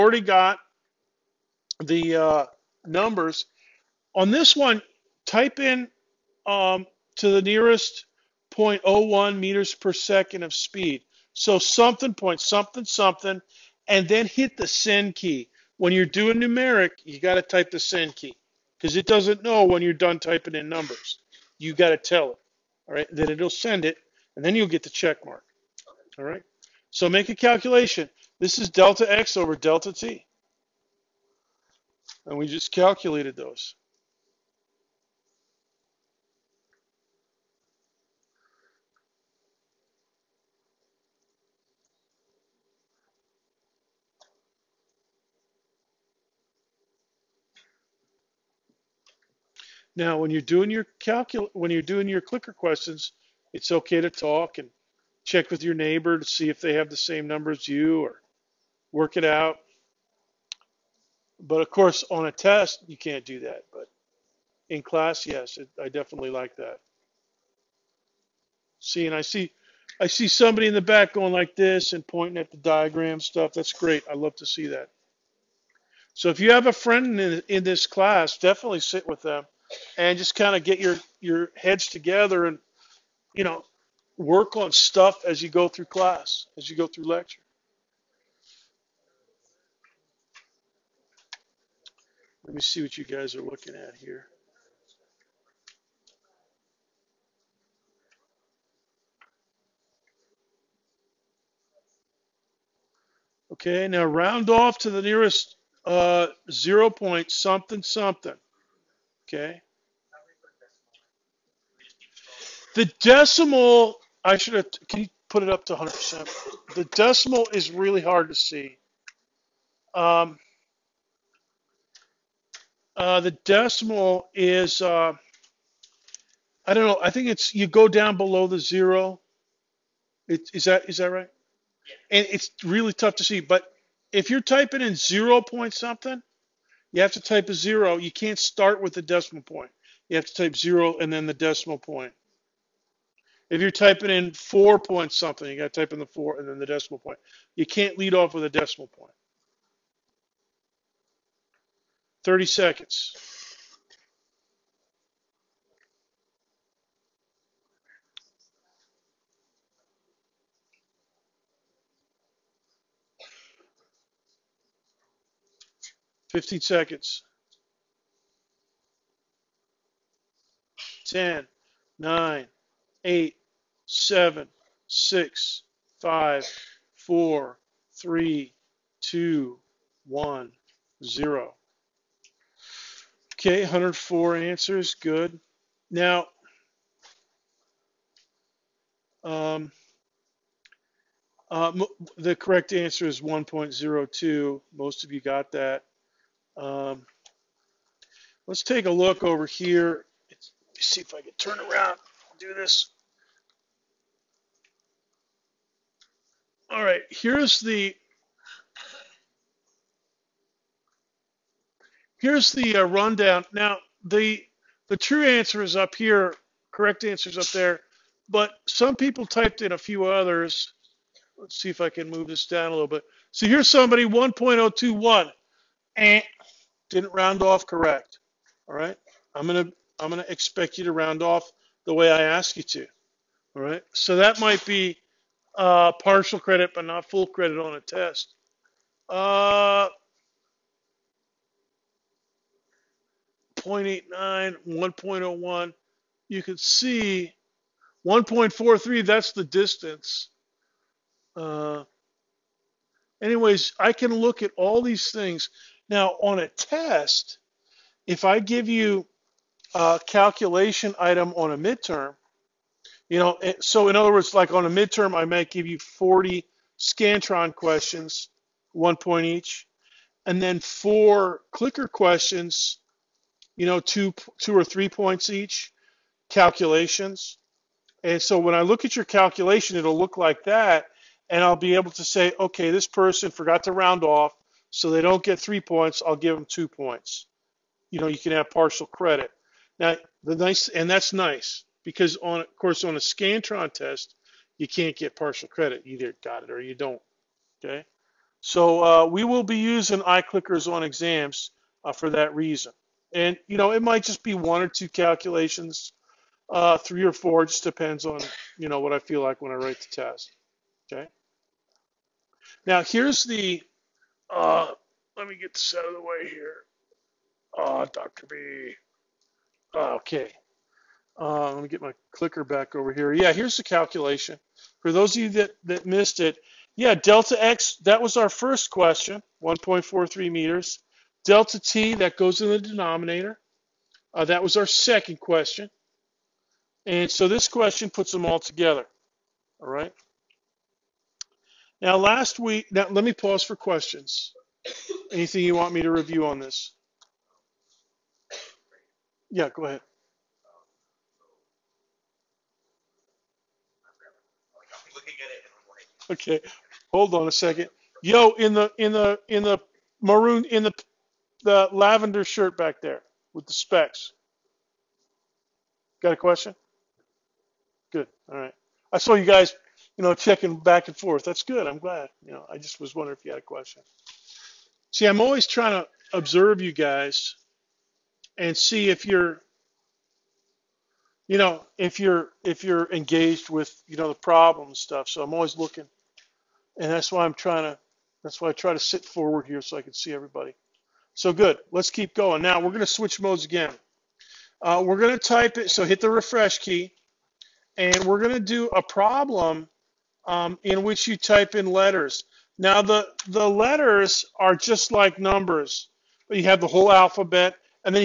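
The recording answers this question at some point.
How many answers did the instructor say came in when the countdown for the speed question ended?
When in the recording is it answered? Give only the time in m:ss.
3:03.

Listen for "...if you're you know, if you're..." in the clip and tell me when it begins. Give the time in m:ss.
6:18.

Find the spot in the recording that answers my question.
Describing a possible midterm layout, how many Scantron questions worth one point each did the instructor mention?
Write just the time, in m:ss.
4:25.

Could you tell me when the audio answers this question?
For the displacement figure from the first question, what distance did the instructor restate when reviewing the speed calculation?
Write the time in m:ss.
5:29.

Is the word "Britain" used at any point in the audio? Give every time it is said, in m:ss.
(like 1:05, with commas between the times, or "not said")
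not said.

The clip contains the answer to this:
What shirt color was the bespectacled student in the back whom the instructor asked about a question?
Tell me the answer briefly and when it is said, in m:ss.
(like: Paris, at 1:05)
lavender, at 6:01.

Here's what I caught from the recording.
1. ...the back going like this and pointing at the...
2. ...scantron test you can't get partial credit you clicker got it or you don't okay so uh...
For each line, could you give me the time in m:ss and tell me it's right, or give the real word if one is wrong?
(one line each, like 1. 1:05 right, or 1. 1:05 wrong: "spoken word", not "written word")
1. 1:10 right
2. 4:52 wrong: "either", not "clicker".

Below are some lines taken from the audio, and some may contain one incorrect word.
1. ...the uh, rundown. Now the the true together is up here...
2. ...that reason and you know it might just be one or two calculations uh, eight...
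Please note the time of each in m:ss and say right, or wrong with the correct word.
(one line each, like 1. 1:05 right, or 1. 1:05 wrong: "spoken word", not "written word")
1. 3:32 wrong: "answer", not "together"
2. 5:02 wrong: "three", not "eight".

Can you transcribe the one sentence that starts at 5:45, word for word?
Anything you want me to review on this?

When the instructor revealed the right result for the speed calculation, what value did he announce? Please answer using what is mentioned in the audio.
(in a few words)
1.02.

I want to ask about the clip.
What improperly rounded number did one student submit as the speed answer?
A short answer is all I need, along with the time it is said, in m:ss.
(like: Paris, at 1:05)
1.021, at 3:44.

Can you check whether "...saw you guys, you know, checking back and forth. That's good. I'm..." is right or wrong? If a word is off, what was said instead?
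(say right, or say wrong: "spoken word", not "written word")
right.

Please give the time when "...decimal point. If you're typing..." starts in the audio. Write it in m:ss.
2:21.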